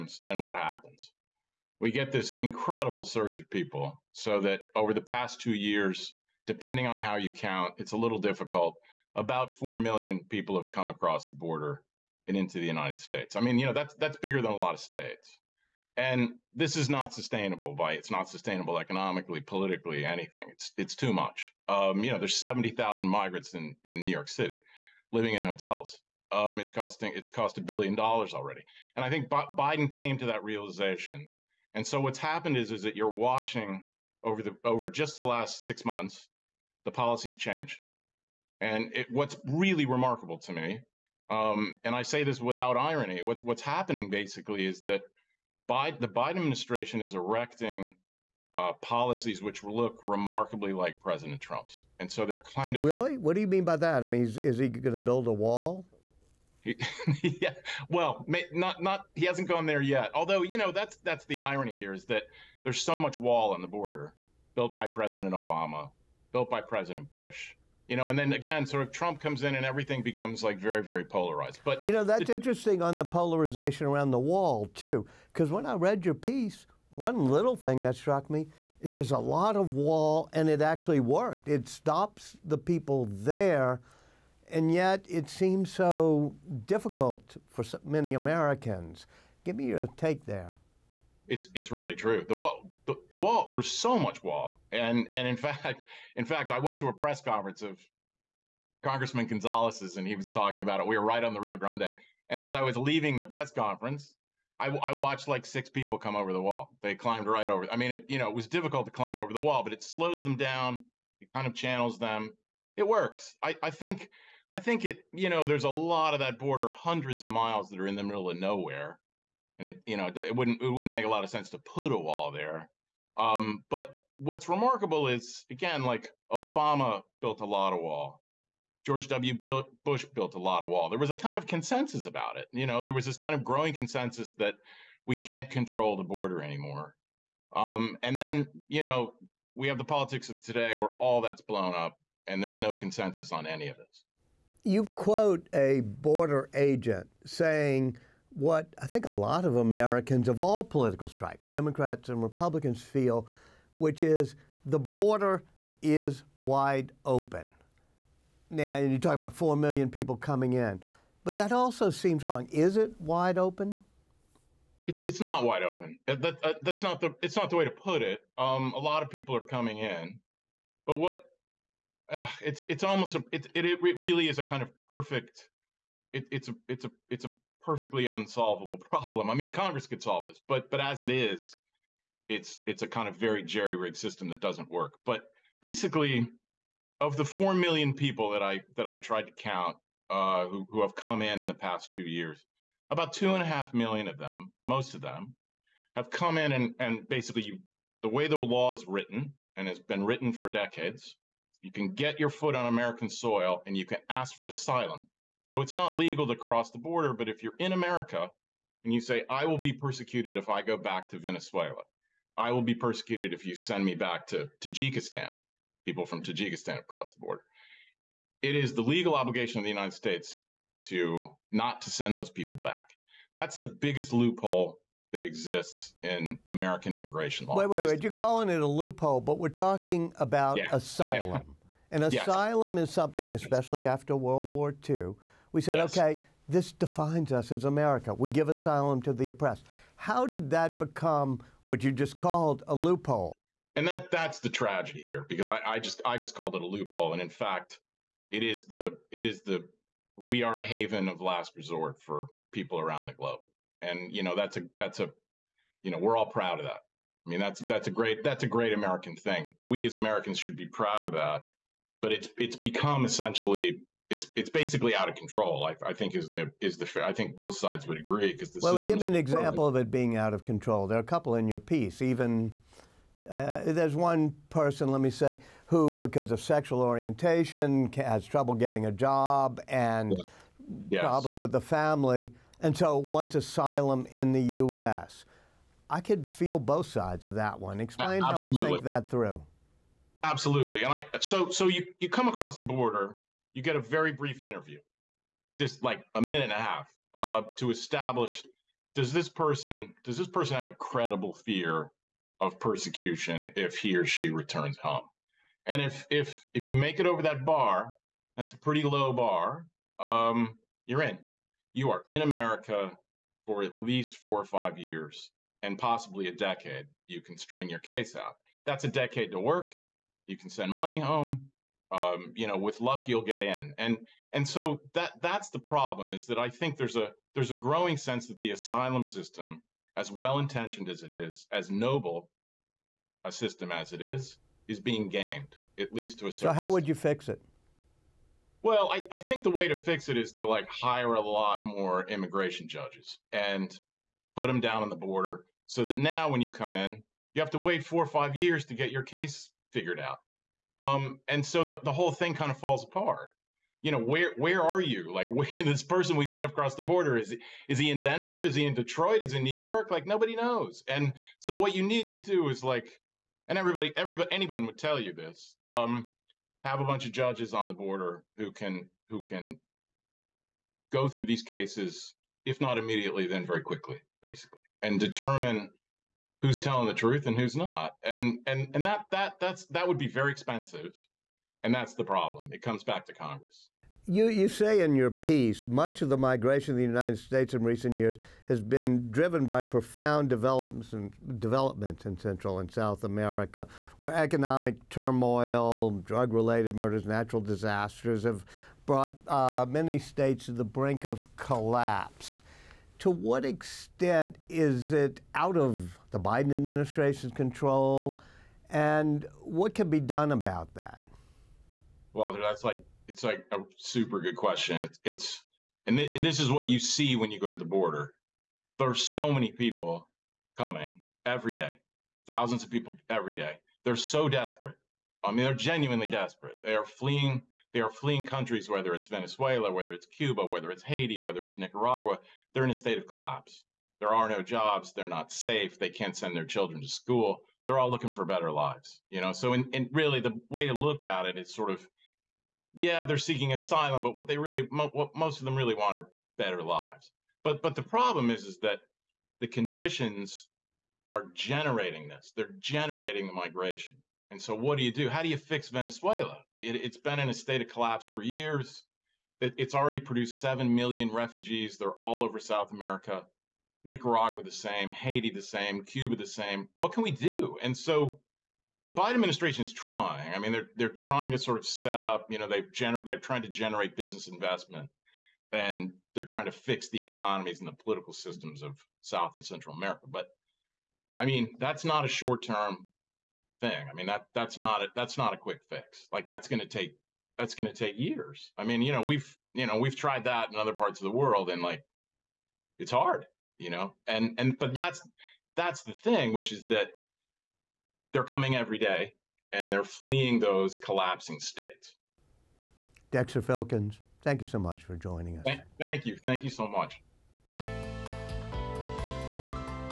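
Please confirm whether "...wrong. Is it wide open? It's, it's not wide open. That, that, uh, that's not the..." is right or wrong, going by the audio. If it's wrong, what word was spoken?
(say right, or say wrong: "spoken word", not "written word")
right.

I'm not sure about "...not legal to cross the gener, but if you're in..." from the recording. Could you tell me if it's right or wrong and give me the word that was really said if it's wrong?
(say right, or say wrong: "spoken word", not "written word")
wrong: "border", not "gener".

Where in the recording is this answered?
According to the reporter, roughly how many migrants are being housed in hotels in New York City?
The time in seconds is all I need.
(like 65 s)
22 s.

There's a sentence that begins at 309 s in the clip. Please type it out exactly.
Um, you're in you are in America for at least four or five years and possibly a decade.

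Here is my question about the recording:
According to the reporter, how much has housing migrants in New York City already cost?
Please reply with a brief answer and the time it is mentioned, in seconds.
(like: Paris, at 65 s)
a billion dollars, at 27 s.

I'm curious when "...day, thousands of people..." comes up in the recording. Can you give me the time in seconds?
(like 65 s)
421 s.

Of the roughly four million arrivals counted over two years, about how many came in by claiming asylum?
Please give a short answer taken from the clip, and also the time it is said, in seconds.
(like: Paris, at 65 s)
2.5 million, at 193 s.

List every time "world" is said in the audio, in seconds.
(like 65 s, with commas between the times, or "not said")
234 s, 491 s.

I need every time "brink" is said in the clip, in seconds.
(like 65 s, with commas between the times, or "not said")
400 s.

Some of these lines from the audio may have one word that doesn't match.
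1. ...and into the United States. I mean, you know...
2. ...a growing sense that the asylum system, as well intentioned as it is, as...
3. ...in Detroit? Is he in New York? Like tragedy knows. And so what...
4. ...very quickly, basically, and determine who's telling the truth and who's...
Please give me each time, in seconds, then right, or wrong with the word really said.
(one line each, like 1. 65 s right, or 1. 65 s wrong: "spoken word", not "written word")
1. 12 s right
2. 327 s right
3. 358 s wrong: "nobody", not "tragedy"
4. 373 s right.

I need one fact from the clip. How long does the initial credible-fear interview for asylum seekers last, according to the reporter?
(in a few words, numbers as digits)
a minute and a half.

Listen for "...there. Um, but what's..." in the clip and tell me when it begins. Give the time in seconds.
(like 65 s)
122 s.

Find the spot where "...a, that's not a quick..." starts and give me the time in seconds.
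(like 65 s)
484 s.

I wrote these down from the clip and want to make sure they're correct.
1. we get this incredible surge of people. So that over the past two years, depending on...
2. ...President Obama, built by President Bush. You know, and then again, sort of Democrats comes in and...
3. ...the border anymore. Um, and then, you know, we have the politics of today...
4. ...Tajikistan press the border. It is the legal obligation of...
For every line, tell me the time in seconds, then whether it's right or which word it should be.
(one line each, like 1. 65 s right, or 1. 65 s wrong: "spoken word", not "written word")
1. 1 s right
2. 64 s wrong: "Trump", not "Democrats"
3. 135 s right
4. 216 s wrong: "across", not "press".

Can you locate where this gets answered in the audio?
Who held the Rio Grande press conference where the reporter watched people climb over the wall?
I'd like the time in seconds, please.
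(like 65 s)
98 s.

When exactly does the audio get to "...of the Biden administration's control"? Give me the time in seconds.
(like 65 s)
405 s.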